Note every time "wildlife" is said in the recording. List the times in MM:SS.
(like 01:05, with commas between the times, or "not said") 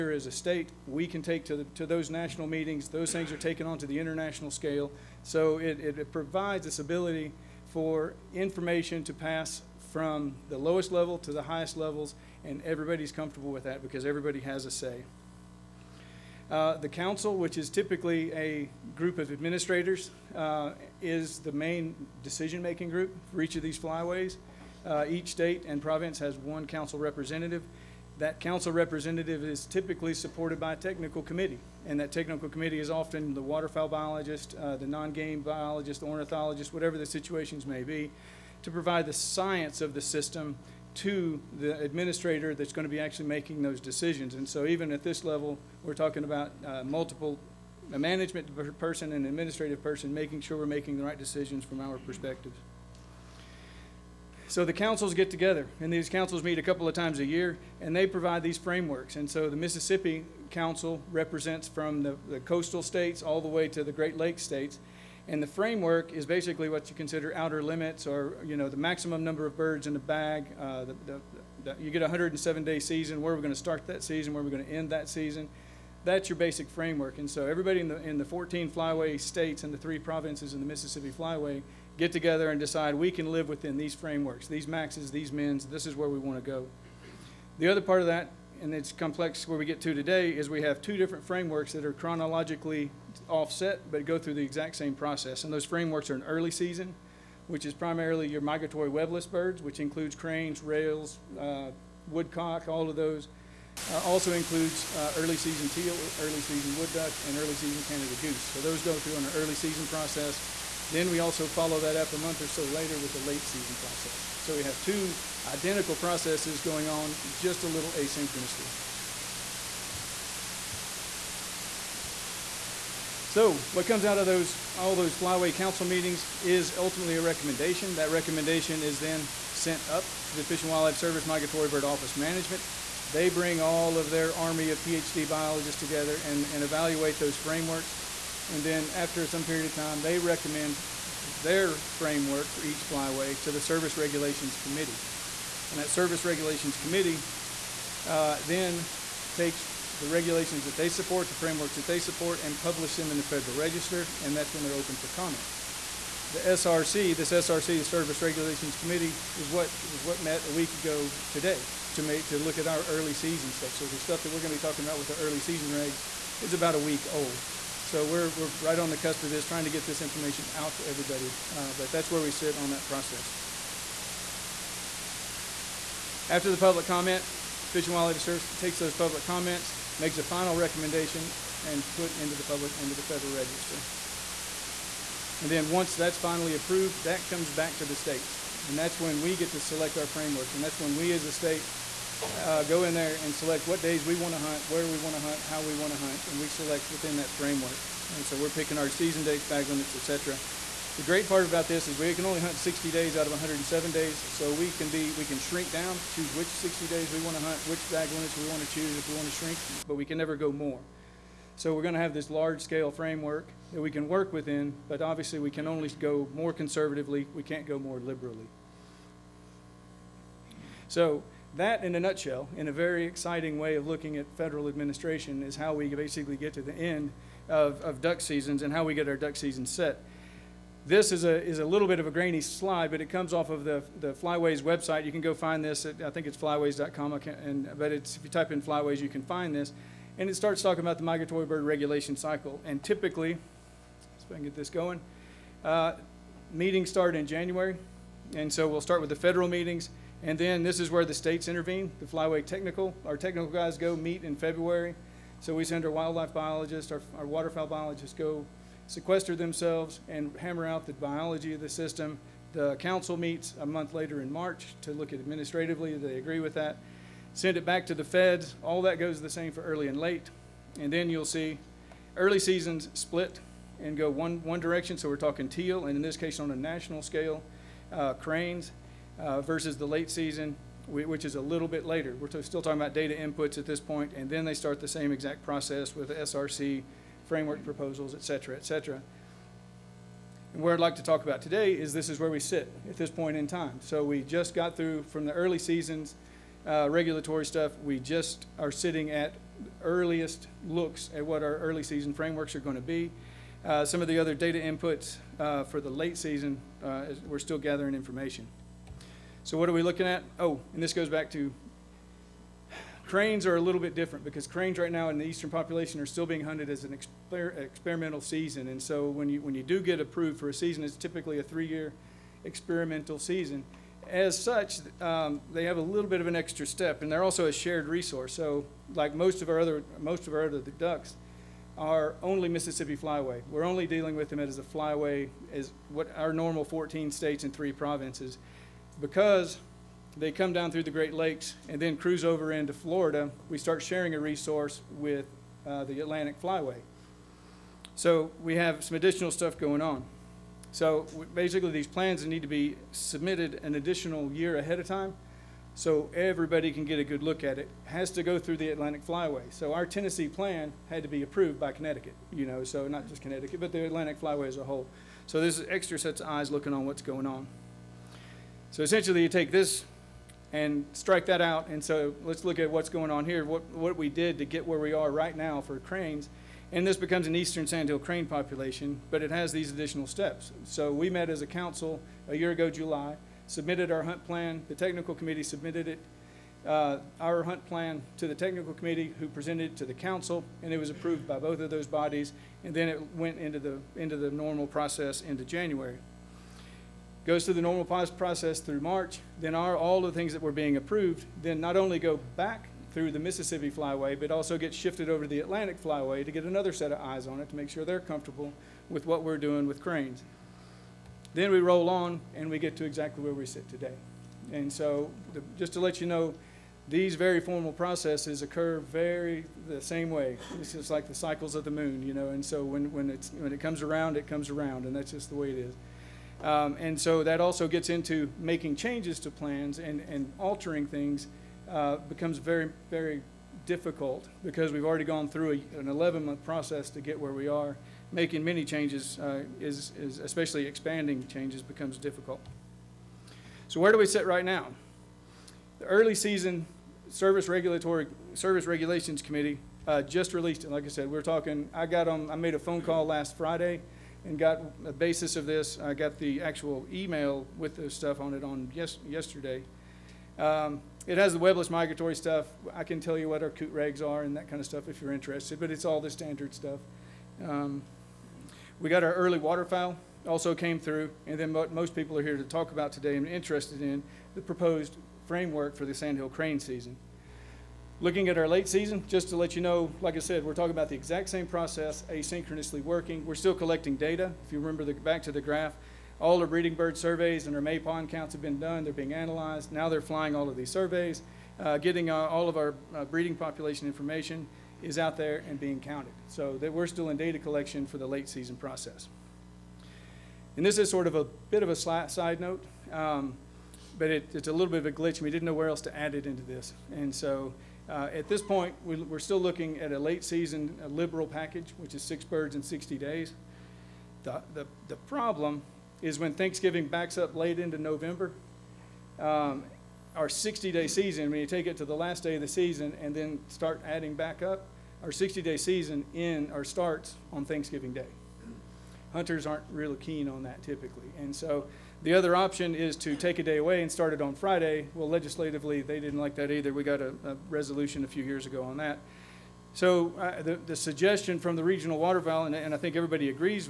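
02:10, 02:57, 04:15.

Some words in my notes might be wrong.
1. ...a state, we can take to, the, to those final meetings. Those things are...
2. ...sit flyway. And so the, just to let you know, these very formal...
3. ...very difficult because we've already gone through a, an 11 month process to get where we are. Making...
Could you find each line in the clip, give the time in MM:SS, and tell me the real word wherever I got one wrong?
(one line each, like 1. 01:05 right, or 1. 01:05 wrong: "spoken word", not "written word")
1. 00:00 wrong: "national", not "final"
2. 06:53 wrong: "today", not "flyway"
3. 07:12 right.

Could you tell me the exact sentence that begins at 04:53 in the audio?
So we just got through from the early seasons, uh, regulatory stuff.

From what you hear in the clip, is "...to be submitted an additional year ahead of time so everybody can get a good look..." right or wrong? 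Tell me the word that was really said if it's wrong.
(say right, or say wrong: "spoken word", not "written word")
right.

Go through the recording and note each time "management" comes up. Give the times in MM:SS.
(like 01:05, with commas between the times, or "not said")
00:47, 02:12.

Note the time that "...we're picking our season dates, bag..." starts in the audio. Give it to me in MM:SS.
03:18.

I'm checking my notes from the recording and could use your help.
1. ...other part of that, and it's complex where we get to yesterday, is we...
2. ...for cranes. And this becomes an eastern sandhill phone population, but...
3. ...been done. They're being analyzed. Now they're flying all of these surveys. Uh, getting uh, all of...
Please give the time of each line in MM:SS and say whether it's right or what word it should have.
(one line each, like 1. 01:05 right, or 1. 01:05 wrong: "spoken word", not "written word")
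1. 01:27 wrong: "today", not "yesterday"
2. 06:15 wrong: "crane", not "phone"
3. 08:08 right.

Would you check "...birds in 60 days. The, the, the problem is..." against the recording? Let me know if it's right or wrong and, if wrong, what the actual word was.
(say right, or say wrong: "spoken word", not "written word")
right.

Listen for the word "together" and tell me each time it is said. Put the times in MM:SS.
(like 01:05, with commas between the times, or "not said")
00:55, 01:22, 02:15.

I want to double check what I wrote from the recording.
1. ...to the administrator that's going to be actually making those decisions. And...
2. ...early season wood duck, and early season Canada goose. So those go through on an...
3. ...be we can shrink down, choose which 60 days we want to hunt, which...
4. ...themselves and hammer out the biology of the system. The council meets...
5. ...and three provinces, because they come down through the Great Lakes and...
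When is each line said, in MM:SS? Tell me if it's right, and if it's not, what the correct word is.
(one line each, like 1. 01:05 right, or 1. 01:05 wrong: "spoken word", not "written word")
1. 00:40 right
2. 01:46 right
3. 03:24 right
4. 04:19 right
5. 05:37 right.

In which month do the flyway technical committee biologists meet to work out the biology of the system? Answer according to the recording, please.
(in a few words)
February.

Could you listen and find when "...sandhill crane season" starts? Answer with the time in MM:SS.
07:55.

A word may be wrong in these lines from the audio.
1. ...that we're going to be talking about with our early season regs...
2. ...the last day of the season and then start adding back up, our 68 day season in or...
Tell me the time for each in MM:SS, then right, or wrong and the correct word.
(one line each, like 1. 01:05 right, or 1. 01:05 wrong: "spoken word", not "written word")
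1. 02:44 right
2. 08:41 wrong: "60", not "68".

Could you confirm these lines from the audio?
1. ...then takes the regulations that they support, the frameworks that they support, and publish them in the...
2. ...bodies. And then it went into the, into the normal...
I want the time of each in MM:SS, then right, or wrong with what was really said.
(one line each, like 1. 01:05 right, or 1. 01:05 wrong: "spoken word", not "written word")
1. 02:28 right
2. 06:31 right.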